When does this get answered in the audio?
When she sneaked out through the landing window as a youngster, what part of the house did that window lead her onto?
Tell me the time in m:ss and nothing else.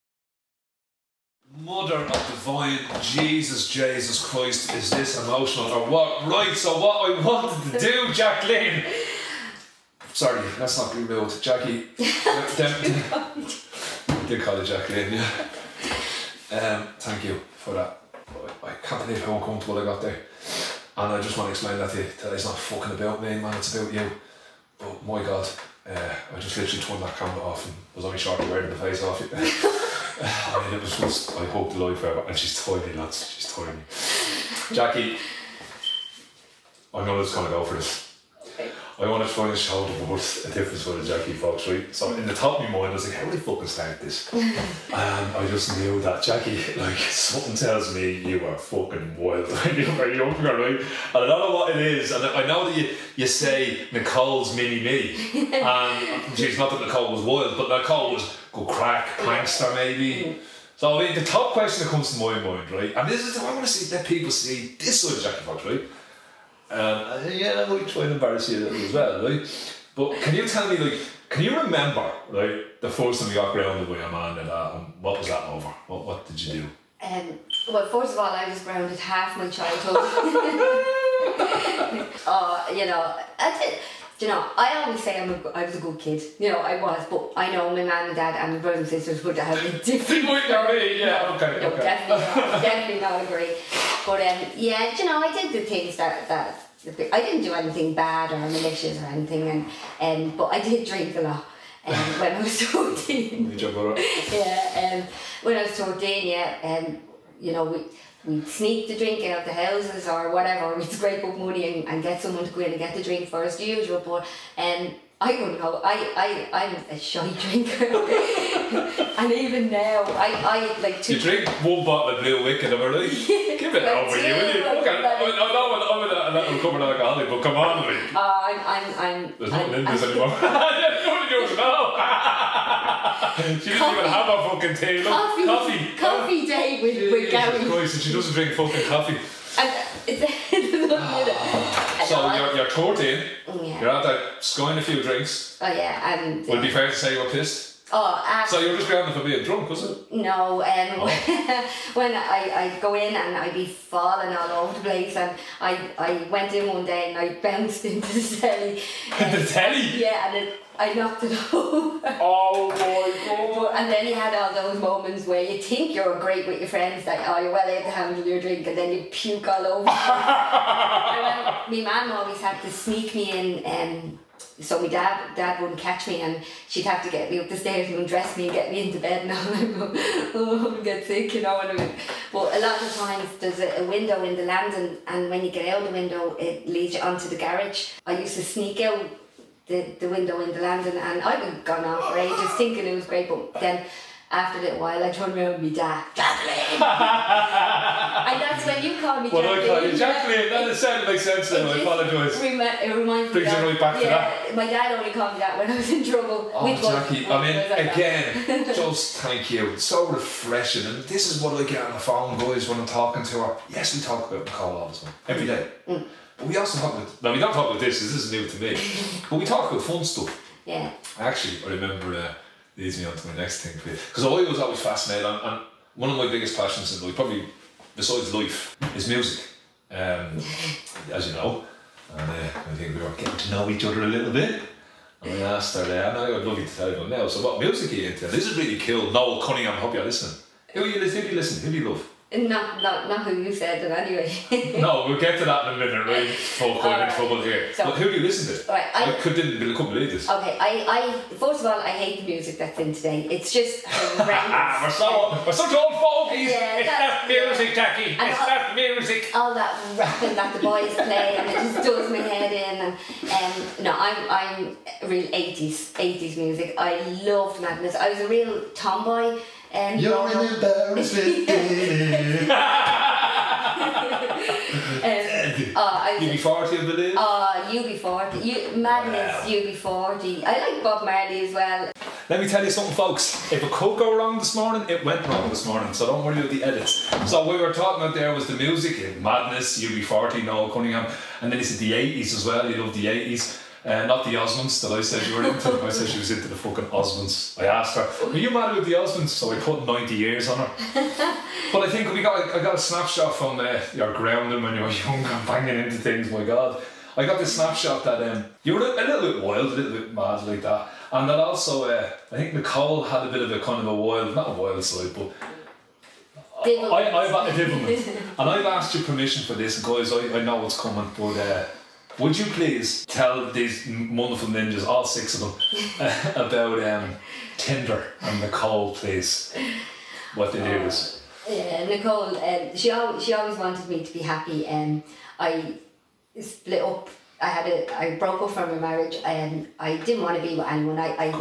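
3:07.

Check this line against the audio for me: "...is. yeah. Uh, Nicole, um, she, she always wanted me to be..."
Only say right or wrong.
right.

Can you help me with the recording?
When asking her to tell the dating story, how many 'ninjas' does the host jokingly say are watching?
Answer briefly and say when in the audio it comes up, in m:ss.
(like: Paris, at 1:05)
6, at 5:25.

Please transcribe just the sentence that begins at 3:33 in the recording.
Yes, we talk about Nicole all the time, every day.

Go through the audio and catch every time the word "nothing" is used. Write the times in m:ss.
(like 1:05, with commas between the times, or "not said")
2:09.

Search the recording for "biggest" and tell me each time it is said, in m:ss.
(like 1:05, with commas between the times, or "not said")
3:46.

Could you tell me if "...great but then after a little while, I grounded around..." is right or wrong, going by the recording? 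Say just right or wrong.
wrong.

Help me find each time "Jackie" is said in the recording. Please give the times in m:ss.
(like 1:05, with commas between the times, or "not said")
0:11, 0:34, 0:41, 0:46, 1:05, 3:26, 4:17.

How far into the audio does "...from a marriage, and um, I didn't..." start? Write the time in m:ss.
5:38.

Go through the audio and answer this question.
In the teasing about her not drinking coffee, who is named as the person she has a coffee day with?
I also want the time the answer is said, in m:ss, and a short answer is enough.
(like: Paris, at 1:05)
Gary, at 2:17.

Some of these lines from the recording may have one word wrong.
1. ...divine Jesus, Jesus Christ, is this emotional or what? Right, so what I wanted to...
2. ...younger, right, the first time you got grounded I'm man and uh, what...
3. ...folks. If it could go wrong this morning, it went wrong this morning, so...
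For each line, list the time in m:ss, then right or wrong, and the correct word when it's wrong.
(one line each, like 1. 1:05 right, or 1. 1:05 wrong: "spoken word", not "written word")
1. 0:02 right
2. 1:11 wrong: "remember", not "younger"
3. 4:42 right.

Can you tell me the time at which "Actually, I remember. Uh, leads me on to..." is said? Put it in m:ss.
3:41.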